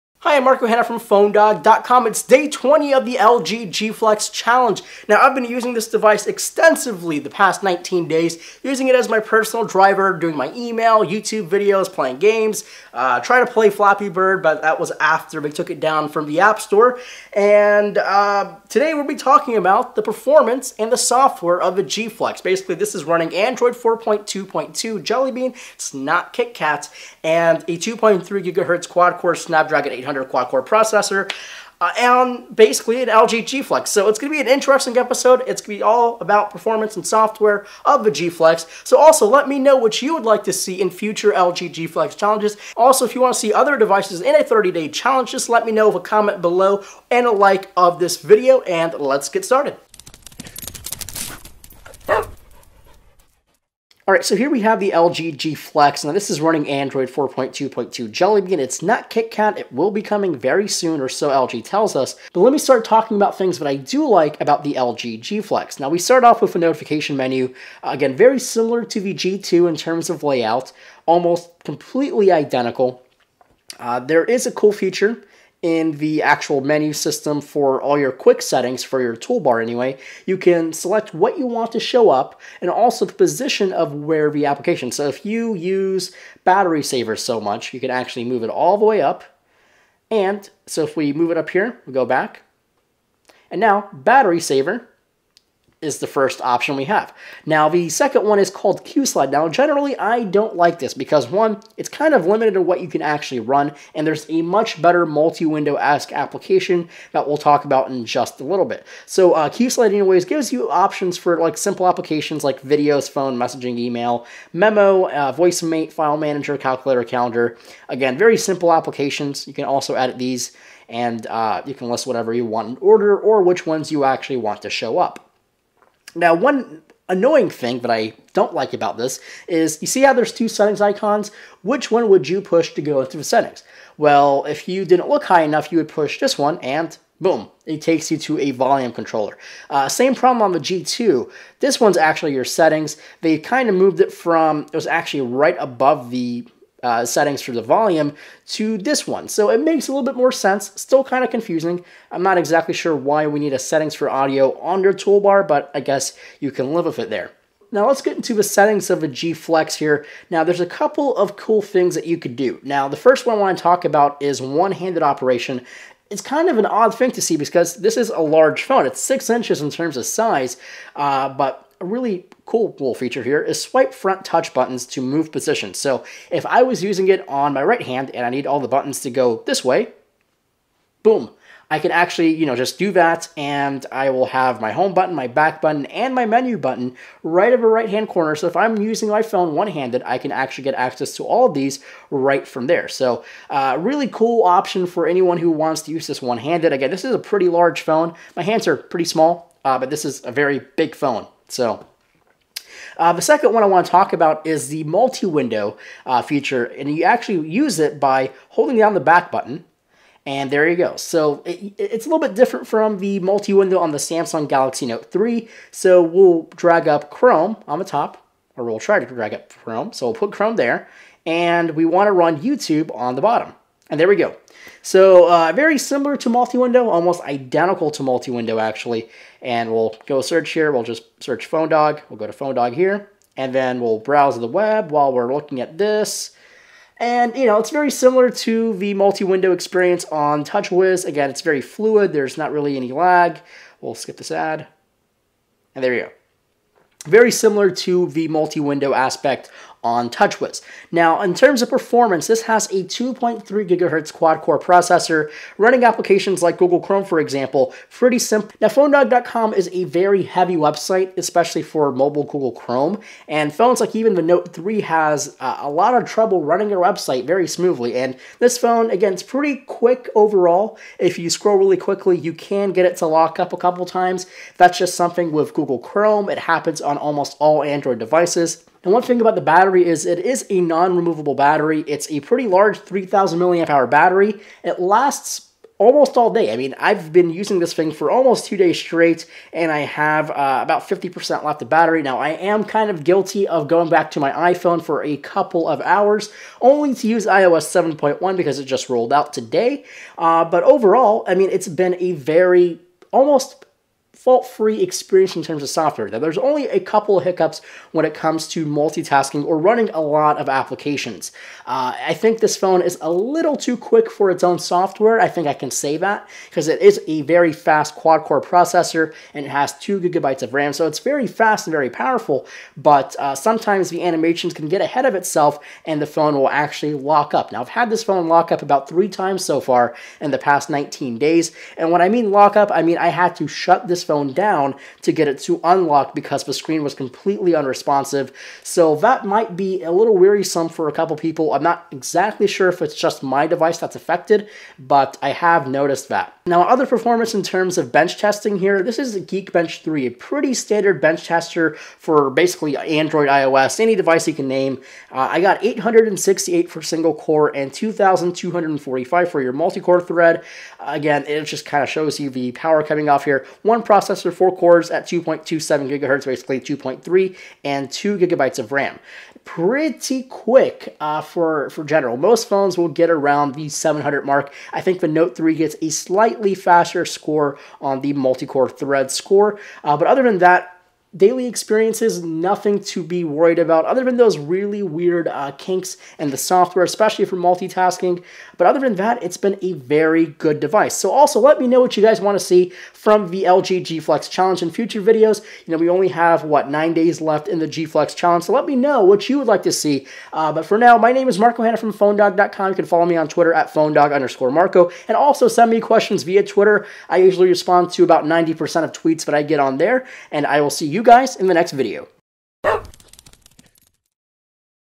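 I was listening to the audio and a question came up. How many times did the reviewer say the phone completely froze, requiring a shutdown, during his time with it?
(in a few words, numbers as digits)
3.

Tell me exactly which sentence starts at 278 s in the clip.
Now, one thing about the battery is it is a non-removable battery.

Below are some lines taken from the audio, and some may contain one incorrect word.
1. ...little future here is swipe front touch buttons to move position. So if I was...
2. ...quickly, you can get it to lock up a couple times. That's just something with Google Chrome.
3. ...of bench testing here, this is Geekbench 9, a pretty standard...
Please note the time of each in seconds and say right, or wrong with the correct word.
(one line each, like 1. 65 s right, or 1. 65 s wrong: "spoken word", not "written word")
1. 172 s wrong: "feature", not "future"
2. 271 s right
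3. 347 s wrong: "3", not "9".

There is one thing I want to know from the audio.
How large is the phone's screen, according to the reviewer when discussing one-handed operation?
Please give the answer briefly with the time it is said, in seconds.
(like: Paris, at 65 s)
6 inches, at 168 s.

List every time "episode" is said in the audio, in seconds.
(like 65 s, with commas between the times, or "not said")
34 s.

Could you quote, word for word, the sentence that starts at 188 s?
So if I'm using my phone one-handed, I can actually get access to all of these right from there.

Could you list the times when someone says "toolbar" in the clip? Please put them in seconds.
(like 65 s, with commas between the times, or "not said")
79 s, 154 s.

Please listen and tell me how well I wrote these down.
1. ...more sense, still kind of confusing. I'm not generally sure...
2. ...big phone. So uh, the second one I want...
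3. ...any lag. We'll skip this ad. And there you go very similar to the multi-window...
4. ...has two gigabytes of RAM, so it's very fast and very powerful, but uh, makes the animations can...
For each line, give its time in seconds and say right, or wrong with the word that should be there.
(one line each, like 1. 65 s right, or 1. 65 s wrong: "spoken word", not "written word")
1. 150 s wrong: "exactly", not "generally"
2. 200 s right
3. 242 s right
4. 319 s wrong: "sometimes", not "makes".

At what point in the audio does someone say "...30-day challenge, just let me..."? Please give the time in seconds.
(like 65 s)
44 s.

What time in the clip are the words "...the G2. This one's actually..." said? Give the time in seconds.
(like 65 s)
140 s.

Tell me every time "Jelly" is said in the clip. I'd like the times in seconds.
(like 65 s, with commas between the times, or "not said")
25 s, 58 s.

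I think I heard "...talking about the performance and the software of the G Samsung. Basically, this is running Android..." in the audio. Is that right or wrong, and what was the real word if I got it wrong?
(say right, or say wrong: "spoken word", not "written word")
wrong: "Flex", not "Samsung".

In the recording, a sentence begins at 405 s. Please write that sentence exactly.
And also send me questions via Twitter.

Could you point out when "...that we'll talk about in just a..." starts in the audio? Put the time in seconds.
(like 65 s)
107 s.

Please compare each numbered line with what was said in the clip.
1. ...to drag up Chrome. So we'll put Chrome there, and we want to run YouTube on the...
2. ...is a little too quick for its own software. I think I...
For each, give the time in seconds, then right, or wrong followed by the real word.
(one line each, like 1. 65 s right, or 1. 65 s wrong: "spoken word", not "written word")
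1. 218 s right
2. 312 s right.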